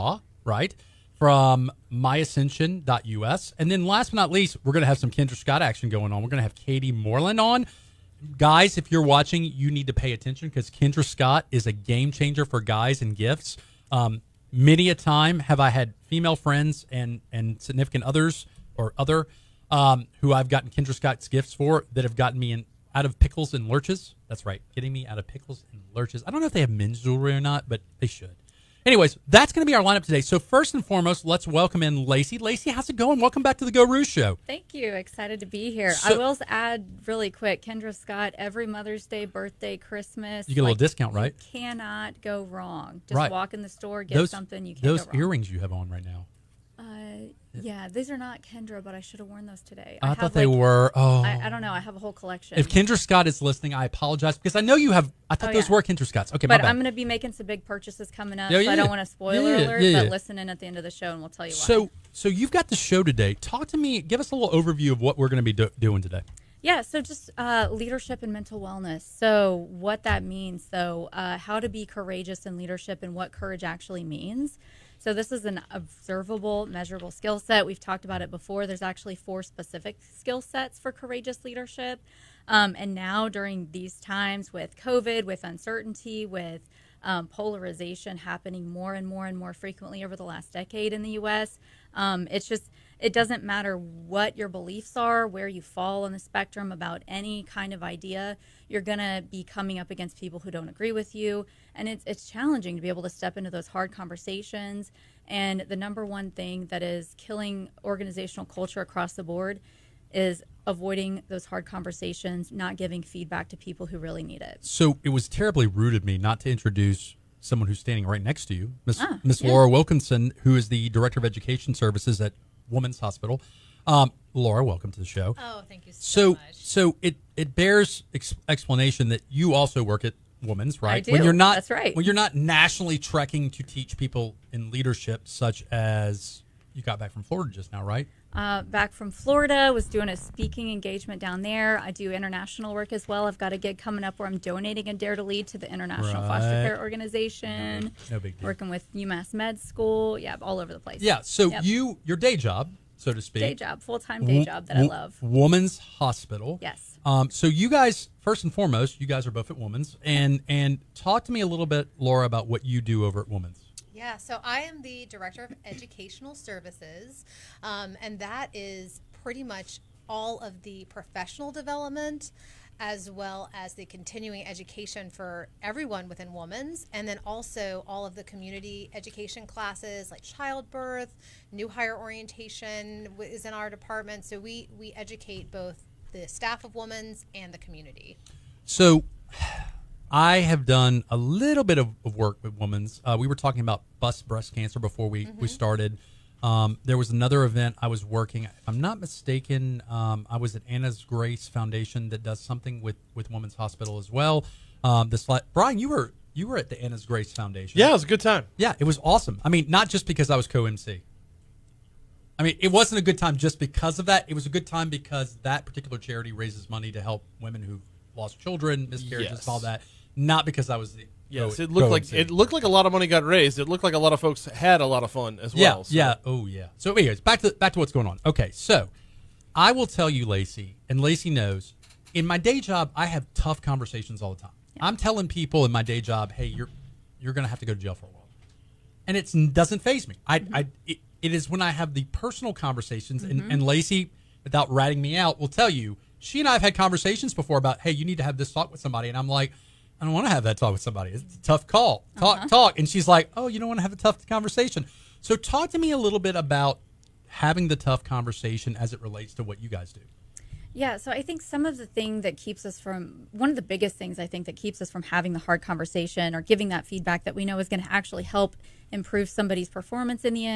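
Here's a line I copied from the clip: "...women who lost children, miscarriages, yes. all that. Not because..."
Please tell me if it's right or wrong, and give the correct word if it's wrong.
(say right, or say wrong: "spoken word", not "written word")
right.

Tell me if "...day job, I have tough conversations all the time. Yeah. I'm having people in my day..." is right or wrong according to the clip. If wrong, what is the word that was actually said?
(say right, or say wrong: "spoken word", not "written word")
wrong: "telling", not "having".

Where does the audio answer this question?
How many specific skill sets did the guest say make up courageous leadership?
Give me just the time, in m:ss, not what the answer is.
1:19.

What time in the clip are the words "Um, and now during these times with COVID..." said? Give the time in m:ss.
1:22.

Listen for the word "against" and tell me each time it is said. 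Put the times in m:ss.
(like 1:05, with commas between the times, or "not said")
1:39.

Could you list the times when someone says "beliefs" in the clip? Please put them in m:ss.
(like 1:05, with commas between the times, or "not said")
1:34.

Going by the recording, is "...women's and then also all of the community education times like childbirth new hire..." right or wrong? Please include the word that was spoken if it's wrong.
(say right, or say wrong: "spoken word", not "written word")
wrong: "classes", not "times".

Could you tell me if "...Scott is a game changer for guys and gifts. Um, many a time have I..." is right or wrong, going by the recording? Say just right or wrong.
right.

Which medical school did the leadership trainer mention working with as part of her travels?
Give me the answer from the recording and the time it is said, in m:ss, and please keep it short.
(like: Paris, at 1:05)
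UMass Med School, at 2:28.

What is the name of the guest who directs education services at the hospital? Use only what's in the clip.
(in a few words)
Laura Wilkinson.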